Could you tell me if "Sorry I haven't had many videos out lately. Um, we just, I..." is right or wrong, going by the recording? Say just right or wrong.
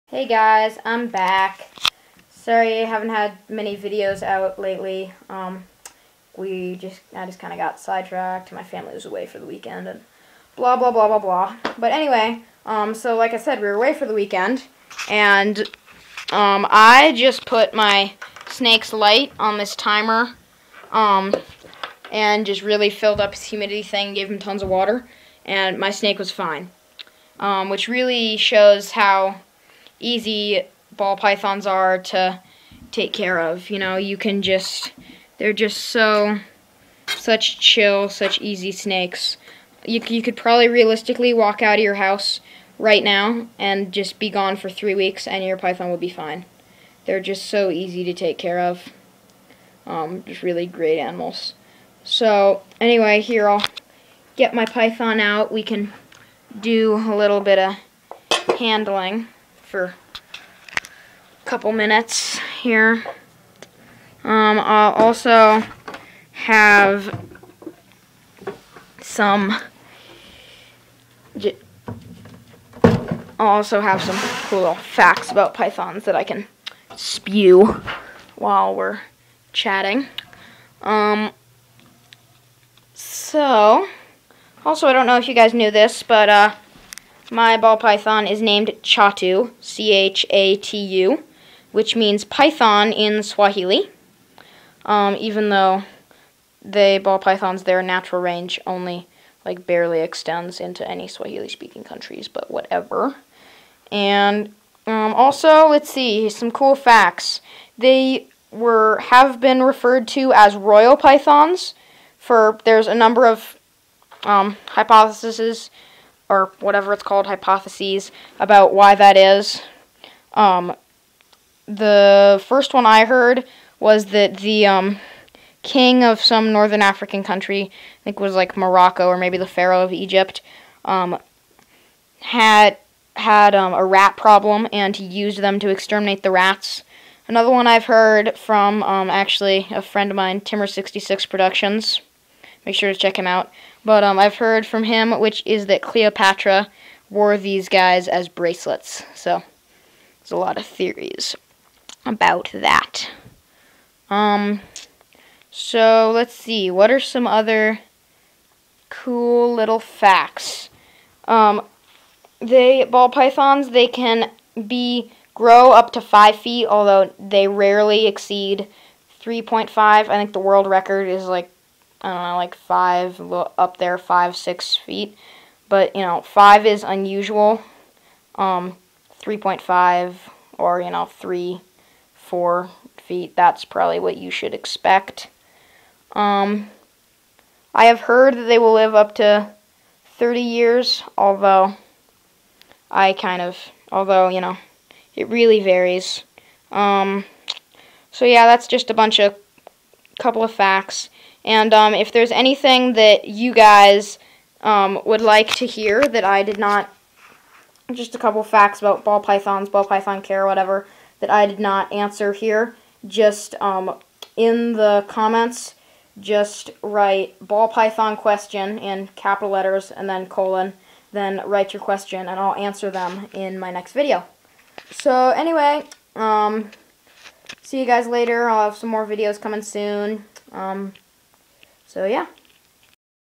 right.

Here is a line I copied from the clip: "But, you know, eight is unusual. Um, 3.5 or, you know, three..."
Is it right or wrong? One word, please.
wrong.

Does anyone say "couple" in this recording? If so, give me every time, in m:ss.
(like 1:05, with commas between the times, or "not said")
1:01, 3:20, 3:28.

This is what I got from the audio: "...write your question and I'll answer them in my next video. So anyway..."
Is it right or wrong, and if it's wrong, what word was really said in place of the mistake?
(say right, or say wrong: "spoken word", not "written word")
right.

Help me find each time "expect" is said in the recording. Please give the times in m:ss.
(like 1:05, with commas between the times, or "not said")
3:04.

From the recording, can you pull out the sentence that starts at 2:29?
So there's a lot of theories about that.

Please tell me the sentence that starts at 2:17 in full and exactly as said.
Another one I've heard from um, actually a friend of mine, Timmer66 Productions.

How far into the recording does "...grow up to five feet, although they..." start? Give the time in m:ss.
2:45.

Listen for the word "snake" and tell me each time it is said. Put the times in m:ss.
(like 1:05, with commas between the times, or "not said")
0:18, 0:25, 0:38.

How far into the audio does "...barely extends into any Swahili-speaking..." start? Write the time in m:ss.
1:39.